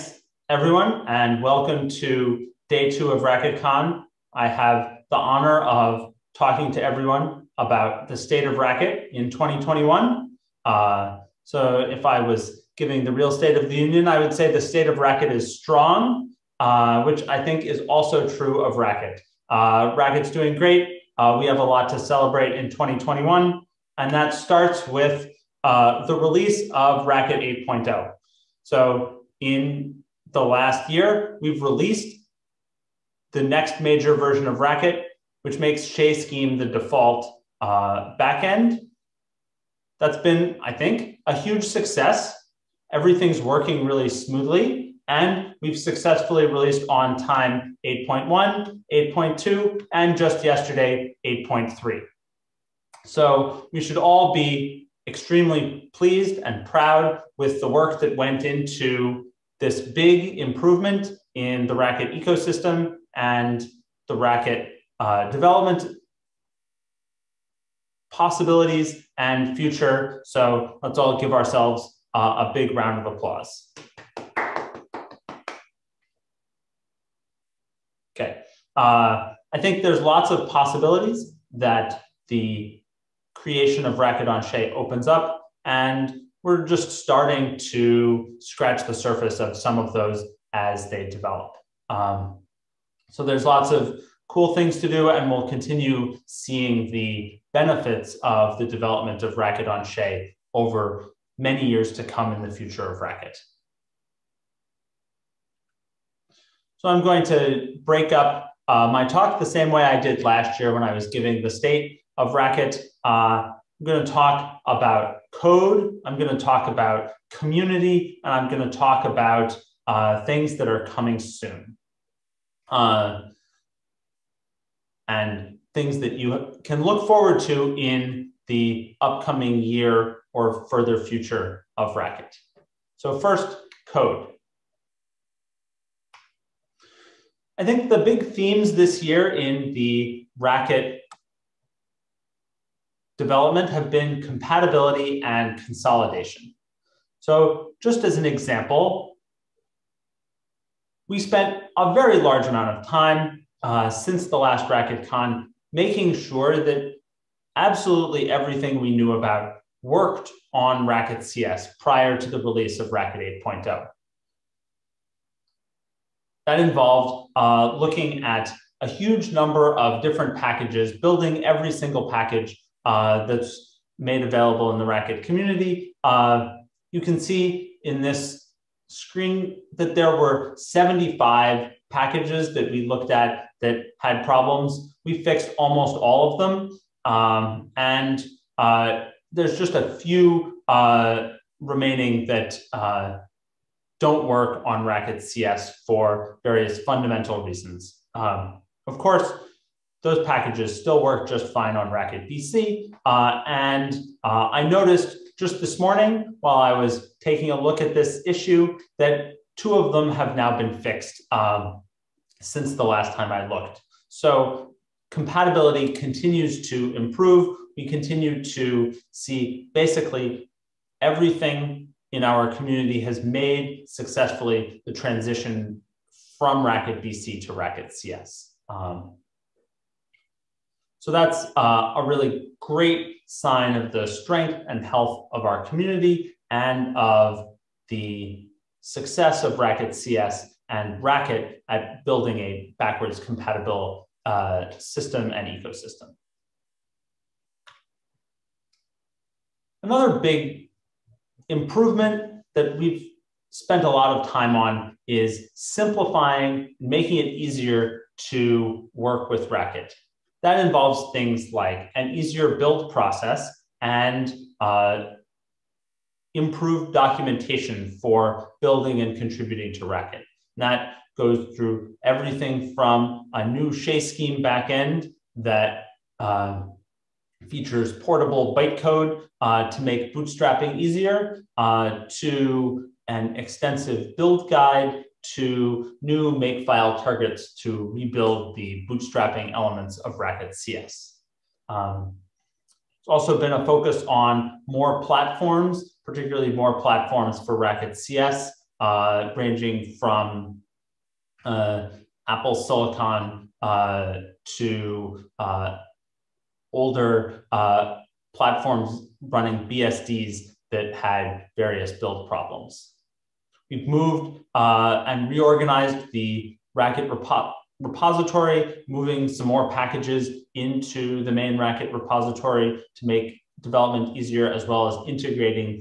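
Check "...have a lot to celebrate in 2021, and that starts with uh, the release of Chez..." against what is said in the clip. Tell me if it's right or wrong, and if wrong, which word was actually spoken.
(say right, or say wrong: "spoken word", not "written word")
wrong: "Racket", not "Chez".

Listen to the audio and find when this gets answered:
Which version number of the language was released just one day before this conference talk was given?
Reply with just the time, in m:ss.
0:51.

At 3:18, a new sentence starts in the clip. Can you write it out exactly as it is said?
Um, of course, those packages still work just fine on Racket BC.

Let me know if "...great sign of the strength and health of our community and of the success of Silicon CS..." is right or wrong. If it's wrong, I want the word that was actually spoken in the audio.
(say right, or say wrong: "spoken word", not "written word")
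wrong: "Racket", not "Silicon".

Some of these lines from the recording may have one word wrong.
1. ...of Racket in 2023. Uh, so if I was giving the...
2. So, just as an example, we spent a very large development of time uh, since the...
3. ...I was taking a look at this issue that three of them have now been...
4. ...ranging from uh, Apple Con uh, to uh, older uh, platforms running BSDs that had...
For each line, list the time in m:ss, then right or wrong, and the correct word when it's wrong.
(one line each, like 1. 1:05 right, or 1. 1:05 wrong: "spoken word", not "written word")
1. 0:08 wrong: "2021", not "2023"
2. 2:27 wrong: "amount", not "development"
3. 3:26 wrong: "two", not "three"
4. 4:59 wrong: "Silicon", not "Con".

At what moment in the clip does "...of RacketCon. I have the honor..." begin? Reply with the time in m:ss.
0:03.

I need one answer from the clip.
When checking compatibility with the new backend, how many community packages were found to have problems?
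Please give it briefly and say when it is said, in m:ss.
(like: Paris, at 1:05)
75, at 3:00.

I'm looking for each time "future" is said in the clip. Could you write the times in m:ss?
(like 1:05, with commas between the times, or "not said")
1:09, 1:42, 2:11.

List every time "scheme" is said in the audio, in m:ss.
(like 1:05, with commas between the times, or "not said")
0:36, 4:34.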